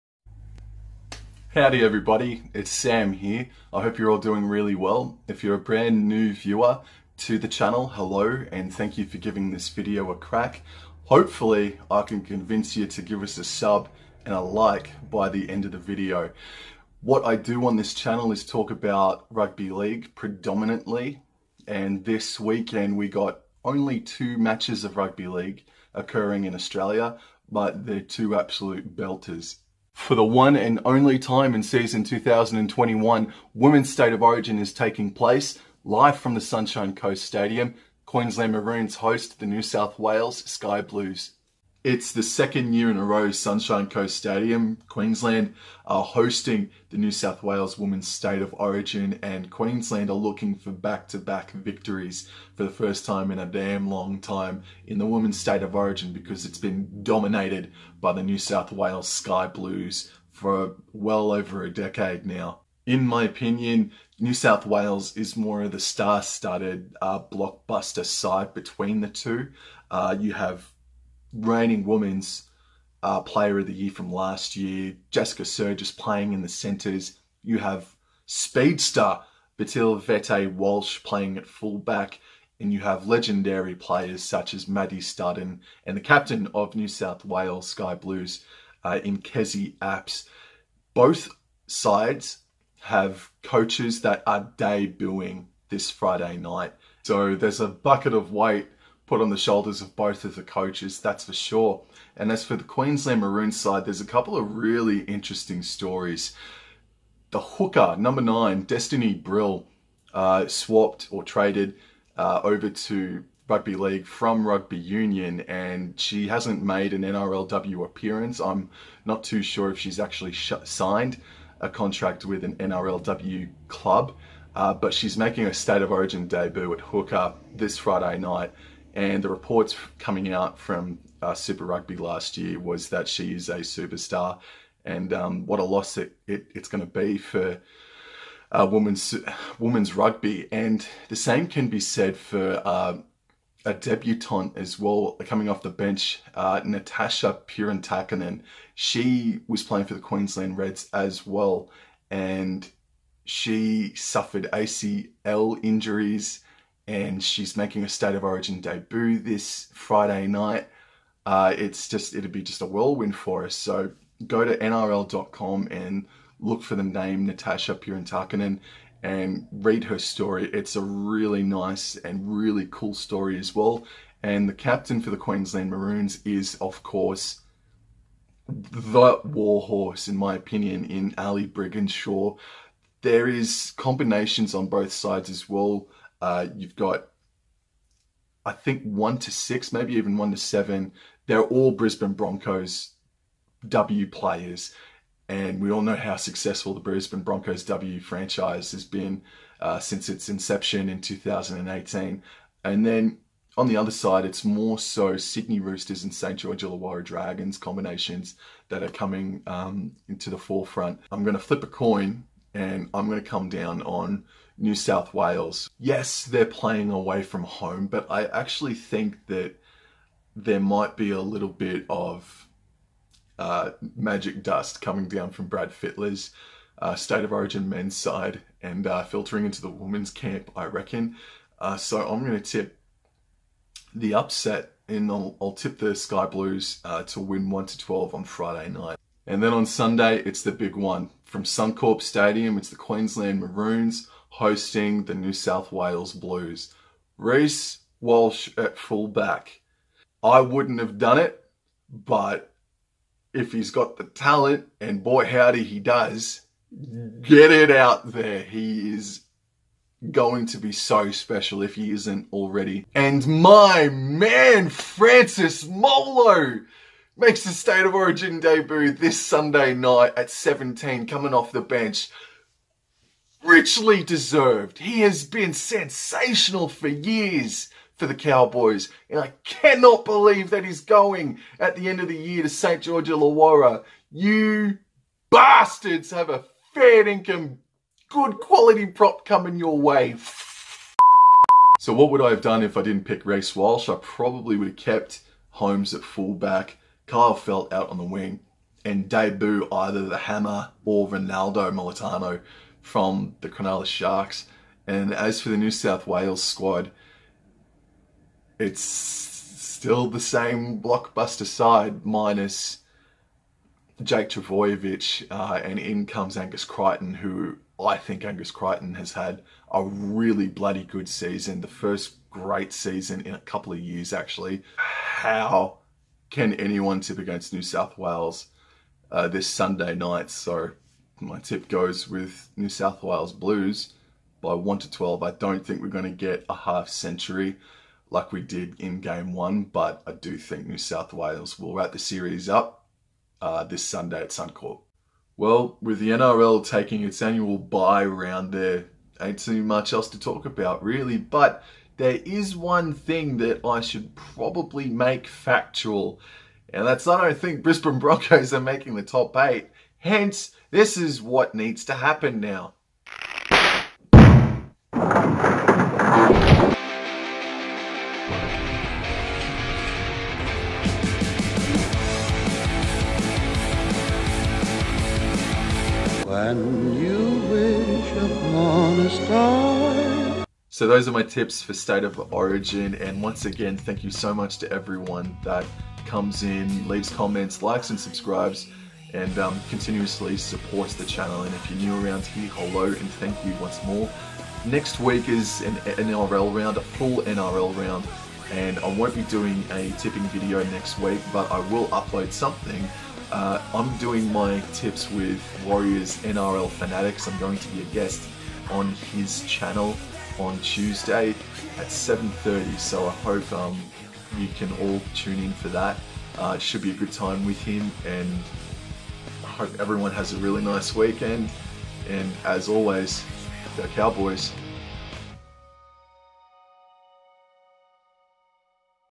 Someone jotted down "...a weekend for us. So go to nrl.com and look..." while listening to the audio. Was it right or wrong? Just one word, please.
wrong.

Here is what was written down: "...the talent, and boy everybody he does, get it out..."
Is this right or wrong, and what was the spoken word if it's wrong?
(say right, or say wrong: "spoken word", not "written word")
wrong: "howdy", not "everybody".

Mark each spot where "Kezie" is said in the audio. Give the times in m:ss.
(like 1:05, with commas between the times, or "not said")
1:29.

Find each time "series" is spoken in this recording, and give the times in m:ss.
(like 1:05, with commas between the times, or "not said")
5:41.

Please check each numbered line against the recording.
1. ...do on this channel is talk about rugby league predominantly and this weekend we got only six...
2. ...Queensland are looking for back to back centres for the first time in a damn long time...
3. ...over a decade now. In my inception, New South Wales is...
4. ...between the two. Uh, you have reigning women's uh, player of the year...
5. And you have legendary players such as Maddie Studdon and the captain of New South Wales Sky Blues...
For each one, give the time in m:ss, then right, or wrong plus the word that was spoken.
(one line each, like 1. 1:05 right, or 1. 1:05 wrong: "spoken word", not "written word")
1. 0:17 wrong: "two", not "six"
2. 0:49 wrong: "victories", not "centres"
3. 1:01 wrong: "opinion", not "inception"
4. 1:08 right
5. 1:22 right.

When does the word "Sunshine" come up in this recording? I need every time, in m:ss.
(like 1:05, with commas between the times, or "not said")
0:36, 0:43.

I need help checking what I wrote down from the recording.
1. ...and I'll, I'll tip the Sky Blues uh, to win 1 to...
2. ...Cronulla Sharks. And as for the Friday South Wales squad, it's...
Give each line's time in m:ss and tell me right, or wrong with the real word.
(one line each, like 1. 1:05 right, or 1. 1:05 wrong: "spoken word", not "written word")
1. 3:54 right
2. 5:03 wrong: "New", not "Friday".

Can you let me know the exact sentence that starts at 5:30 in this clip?
So my tip goes with New South Wales Blues by 1 to 12.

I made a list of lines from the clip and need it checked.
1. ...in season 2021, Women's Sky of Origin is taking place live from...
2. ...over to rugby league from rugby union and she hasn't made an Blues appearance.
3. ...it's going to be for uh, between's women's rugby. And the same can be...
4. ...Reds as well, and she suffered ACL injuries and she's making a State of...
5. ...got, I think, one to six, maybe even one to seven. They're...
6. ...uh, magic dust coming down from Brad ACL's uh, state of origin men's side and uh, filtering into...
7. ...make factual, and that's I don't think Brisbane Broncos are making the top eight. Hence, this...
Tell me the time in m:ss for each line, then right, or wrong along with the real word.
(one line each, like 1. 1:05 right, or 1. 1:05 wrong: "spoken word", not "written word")
1. 0:31 wrong: "State", not "Sky"
2. 1:52 wrong: "NRLW", not "Blues"
3. 2:16 wrong: "women", not "between"
4. 2:30 right
5. 3:06 right
6. 3:43 wrong: "Fittler", not "ACL"
7. 5:54 right.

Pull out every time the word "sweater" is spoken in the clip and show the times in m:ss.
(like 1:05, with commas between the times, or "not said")
not said.